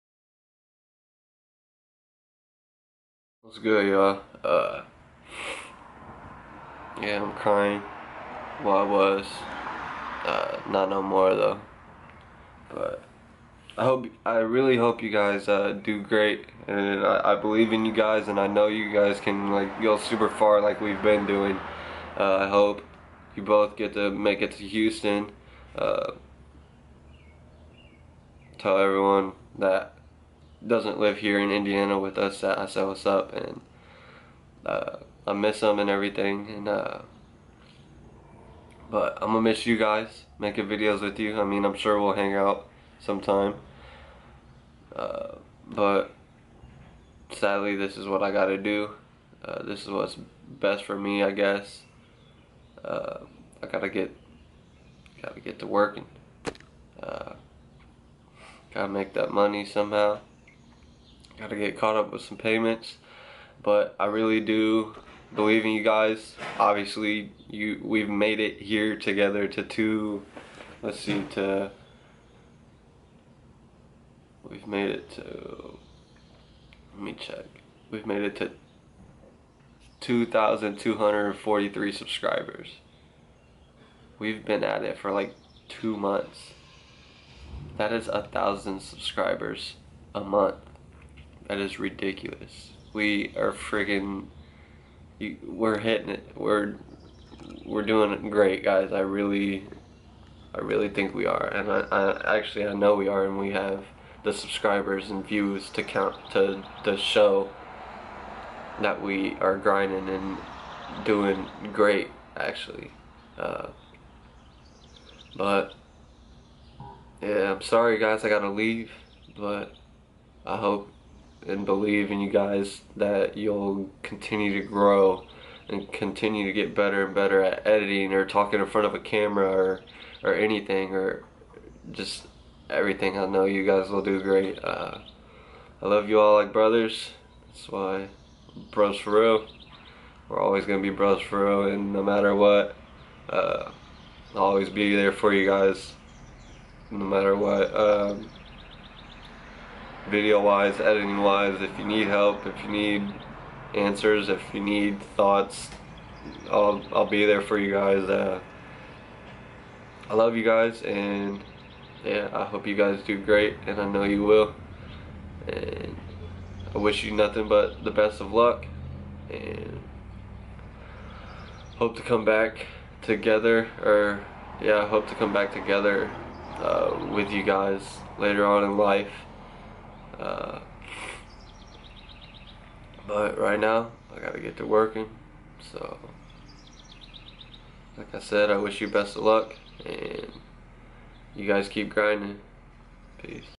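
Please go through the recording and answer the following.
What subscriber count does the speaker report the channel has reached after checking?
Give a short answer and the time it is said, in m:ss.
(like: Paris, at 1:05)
2,243, at 1:20.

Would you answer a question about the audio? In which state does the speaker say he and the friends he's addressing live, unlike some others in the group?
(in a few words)
Indiana.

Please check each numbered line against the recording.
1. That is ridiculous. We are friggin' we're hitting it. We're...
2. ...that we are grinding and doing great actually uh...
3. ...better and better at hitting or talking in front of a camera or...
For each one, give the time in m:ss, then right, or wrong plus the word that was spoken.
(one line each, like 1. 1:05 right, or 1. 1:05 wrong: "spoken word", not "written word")
1. 1:31 right
2. 1:48 right
3. 2:06 wrong: "editing", not "hitting".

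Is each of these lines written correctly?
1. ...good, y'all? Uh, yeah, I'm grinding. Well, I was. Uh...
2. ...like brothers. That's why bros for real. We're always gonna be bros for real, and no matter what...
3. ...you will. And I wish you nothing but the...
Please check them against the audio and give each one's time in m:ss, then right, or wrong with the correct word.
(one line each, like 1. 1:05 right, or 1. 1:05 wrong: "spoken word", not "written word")
1. 0:03 wrong: "crying", not "grinding"
2. 2:16 right
3. 2:44 right.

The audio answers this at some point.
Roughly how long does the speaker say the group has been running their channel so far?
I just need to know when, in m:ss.
1:25.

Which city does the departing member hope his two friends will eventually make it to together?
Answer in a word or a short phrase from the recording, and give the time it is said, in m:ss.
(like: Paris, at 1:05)
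Houston, at 0:24.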